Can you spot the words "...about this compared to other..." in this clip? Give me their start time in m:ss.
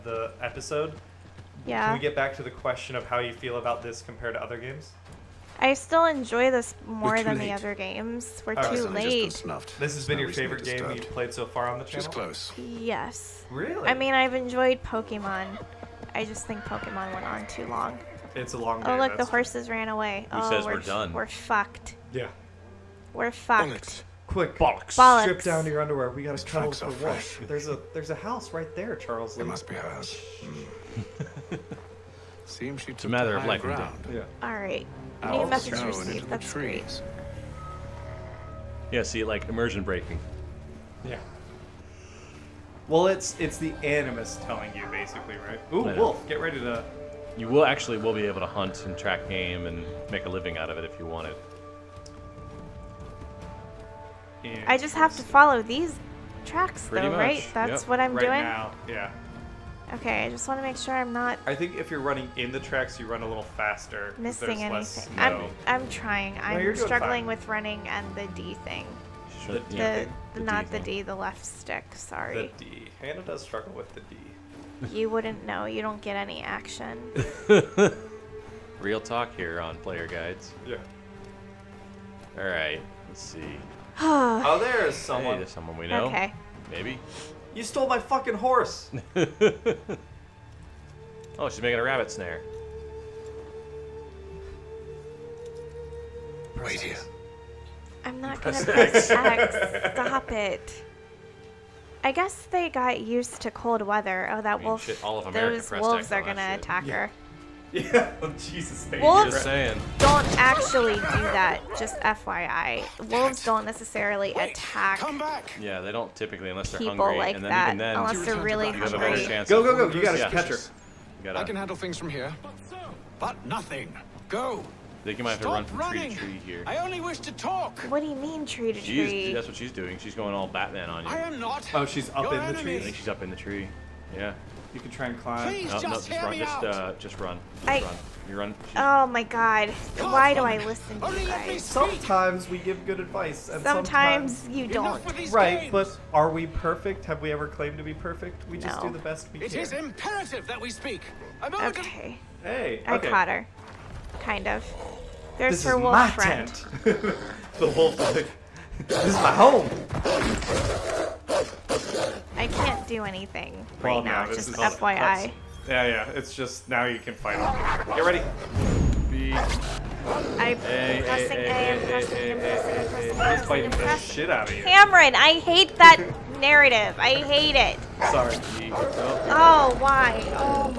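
0:03.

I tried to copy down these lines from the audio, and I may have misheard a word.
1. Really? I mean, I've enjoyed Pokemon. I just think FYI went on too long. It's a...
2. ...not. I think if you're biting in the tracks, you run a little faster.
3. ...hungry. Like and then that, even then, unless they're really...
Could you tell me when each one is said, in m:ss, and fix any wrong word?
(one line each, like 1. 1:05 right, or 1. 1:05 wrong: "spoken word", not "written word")
1. 0:13 wrong: "Pokemon", not "FYI"
2. 1:01 wrong: "running", not "biting"
3. 1:56 right.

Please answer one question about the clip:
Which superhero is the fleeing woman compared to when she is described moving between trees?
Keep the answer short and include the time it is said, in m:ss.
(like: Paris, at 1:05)
Batman, at 2:10.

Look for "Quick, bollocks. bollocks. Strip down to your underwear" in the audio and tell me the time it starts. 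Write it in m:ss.
0:24.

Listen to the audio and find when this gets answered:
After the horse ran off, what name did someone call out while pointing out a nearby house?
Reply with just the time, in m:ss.
0:28.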